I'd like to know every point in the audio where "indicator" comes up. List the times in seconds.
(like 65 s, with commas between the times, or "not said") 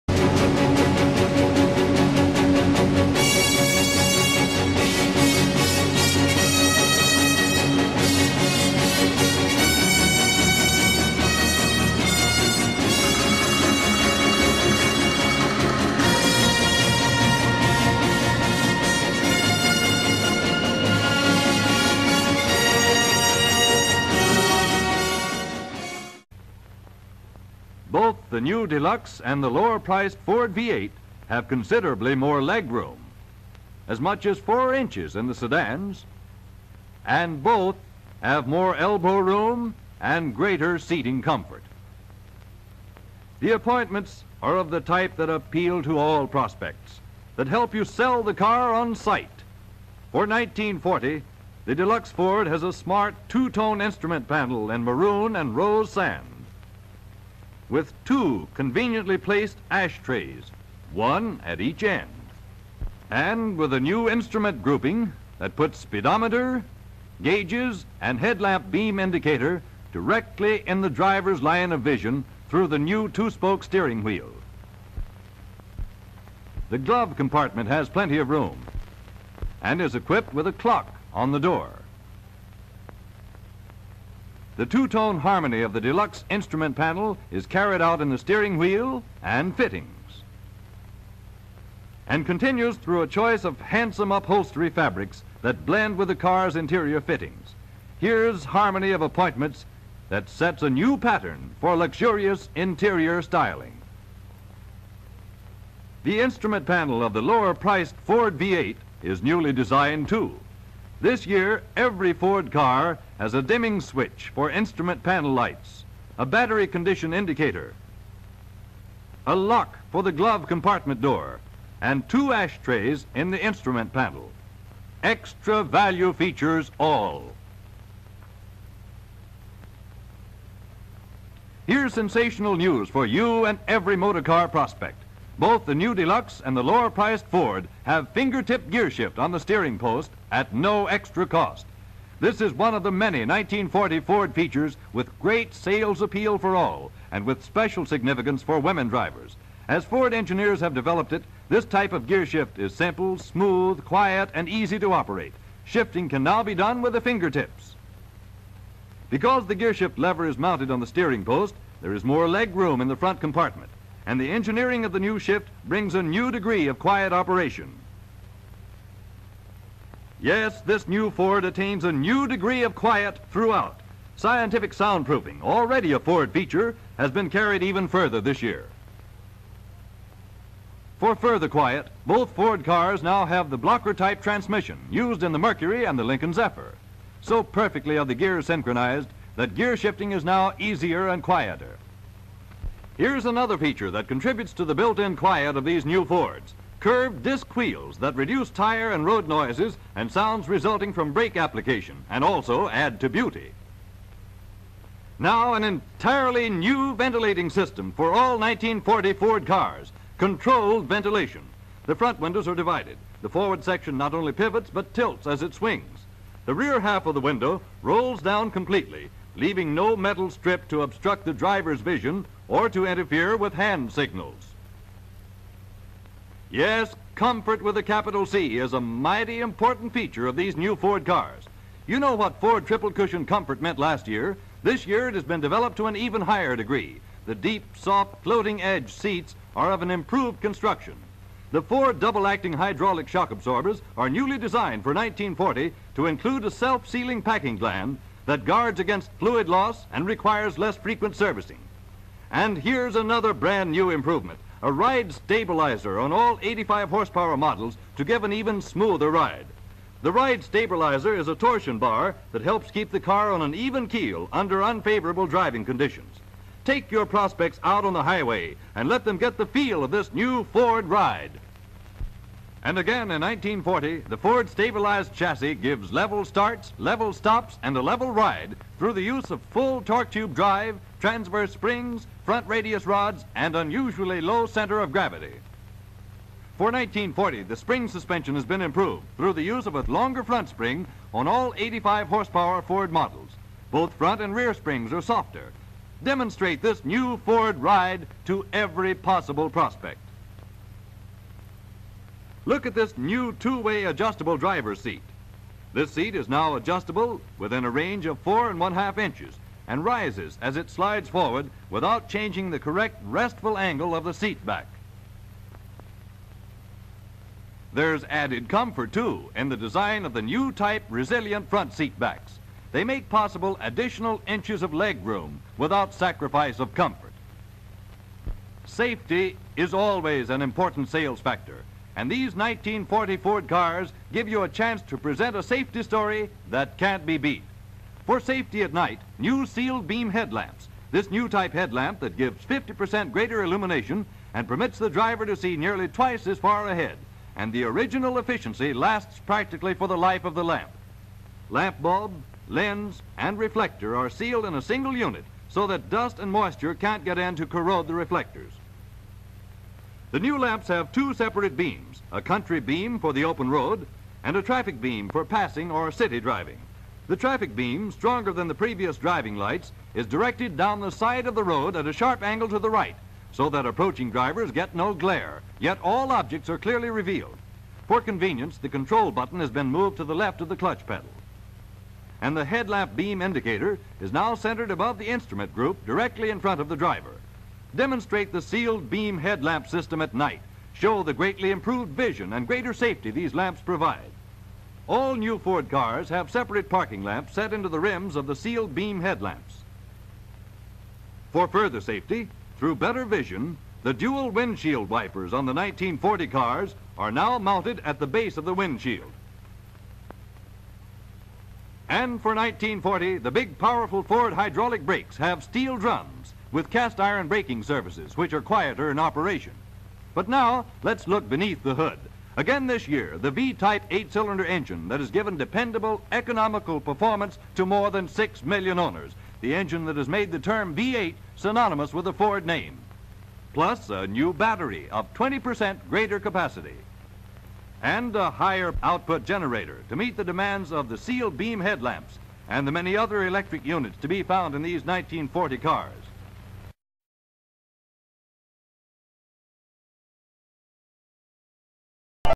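68 s, 117 s, 383 s.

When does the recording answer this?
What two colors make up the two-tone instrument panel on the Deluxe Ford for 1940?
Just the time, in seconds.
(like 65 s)
54 s.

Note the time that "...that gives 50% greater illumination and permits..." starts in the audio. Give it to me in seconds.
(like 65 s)
341 s.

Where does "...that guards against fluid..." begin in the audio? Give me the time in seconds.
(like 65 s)
248 s.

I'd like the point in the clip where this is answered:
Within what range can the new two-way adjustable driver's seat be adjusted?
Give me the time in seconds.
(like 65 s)
308 s.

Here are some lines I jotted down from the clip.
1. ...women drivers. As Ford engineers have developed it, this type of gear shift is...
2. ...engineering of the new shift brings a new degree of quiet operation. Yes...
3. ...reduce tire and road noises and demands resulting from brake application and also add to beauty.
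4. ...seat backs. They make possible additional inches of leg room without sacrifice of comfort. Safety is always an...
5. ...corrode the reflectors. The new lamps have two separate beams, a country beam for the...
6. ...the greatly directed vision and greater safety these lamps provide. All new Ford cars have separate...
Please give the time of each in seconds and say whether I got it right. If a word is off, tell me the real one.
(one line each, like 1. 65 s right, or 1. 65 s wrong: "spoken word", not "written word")
1. 148 s right
2. 164 s right
3. 198 s wrong: "sounds", not "demands"
4. 321 s right
5. 357 s right
6. 391 s wrong: "improved", not "directed".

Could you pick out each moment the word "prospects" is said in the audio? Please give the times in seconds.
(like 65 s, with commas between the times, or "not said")
46 s, 134 s, 267 s, 299 s.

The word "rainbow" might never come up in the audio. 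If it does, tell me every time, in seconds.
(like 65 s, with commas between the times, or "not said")
not said.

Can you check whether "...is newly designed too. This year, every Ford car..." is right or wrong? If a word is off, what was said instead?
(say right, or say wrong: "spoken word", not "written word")
right.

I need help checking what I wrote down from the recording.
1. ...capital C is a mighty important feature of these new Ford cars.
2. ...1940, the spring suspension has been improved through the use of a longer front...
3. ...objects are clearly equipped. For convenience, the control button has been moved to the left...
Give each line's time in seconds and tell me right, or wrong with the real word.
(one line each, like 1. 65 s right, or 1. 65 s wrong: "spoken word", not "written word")
1. 227 s right
2. 286 s right
3. 376 s wrong: "revealed", not "equipped".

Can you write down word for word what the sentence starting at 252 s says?
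And here's another brand new improvement, a ride stabilizer on all 85 horsepower models to give an even smoother ride.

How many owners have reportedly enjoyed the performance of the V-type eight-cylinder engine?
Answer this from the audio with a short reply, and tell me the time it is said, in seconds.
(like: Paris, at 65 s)
more than 6 million, at 427 s.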